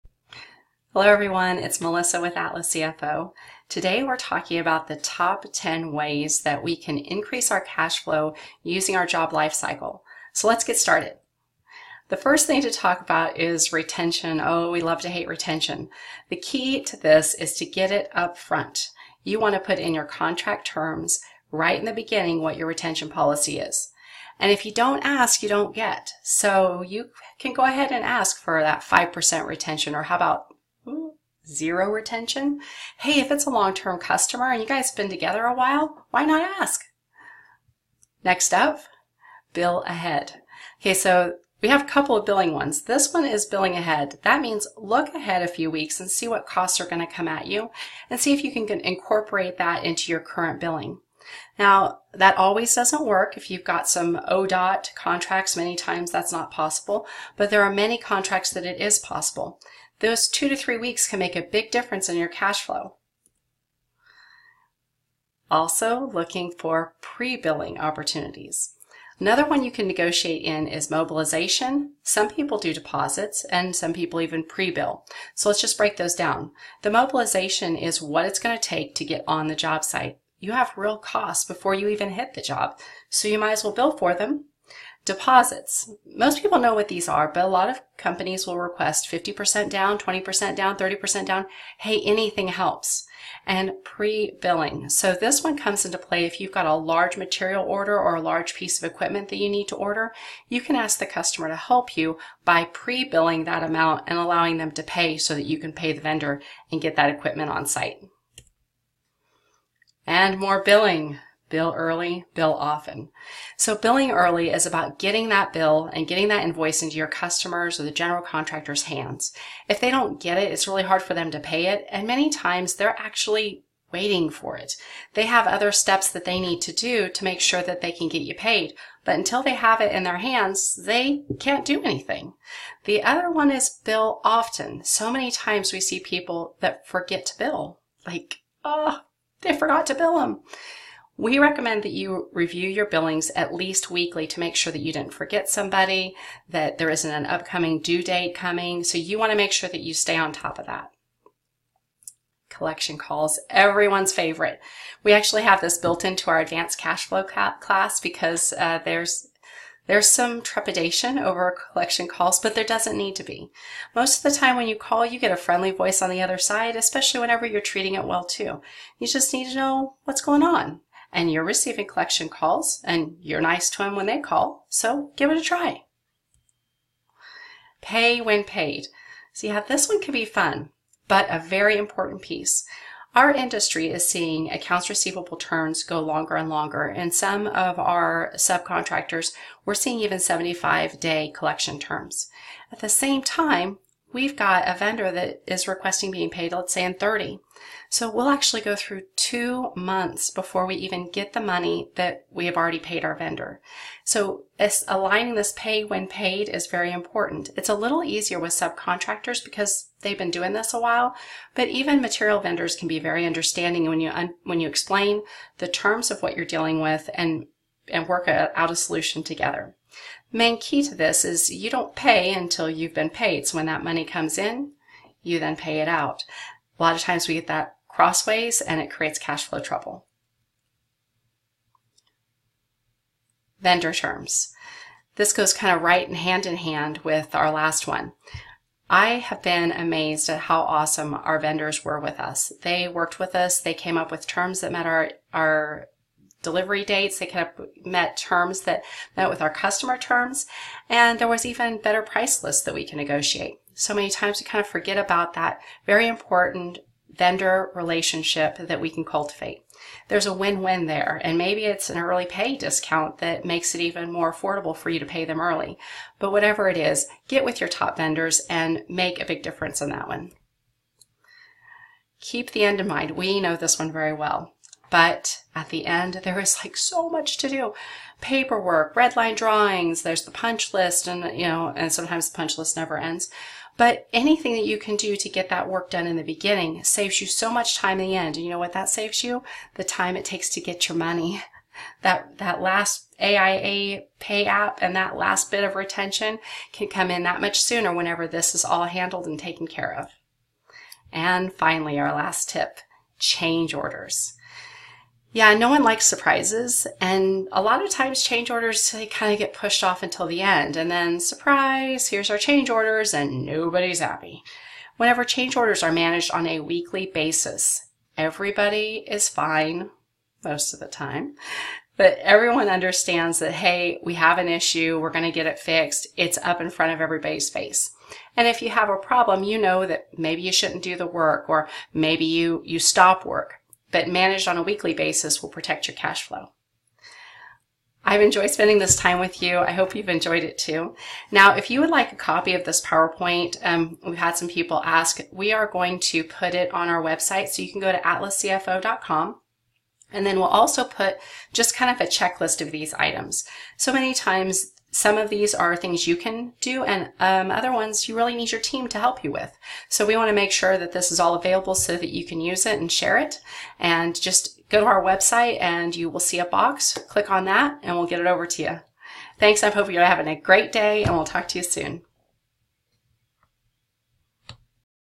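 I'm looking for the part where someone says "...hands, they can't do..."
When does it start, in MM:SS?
02:10.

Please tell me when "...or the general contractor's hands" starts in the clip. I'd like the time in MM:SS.
01:57.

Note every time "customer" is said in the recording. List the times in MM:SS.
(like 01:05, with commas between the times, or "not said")
00:33, 01:41, 01:57, 04:09.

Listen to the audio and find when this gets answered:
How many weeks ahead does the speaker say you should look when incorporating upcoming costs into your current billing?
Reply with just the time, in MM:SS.
01:00.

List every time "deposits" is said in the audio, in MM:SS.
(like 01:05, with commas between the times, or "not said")
01:12, 01:25.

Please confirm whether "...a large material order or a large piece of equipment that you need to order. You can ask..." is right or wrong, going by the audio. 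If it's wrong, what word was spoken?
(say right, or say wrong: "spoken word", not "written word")
right.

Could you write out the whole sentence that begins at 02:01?
And many times they're actually waiting for it.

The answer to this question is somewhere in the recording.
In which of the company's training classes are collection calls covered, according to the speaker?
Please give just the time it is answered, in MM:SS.
02:36.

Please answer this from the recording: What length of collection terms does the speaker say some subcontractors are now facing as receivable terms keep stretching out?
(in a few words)
75 days.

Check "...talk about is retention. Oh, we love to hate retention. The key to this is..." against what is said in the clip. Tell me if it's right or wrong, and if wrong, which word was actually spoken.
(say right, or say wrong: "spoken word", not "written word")
right.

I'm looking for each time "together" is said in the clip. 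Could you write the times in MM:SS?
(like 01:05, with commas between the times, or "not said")
00:35, 03:39.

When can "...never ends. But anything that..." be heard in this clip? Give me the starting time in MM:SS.
04:42.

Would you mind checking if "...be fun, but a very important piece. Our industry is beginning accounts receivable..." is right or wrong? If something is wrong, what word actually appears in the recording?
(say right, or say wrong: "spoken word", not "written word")
wrong: "seeing", not "beginning".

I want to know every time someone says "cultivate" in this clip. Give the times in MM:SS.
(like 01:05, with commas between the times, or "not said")
04:19.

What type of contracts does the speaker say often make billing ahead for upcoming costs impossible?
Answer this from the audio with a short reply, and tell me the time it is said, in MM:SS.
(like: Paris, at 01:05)
ODOT contracts, at 00:54.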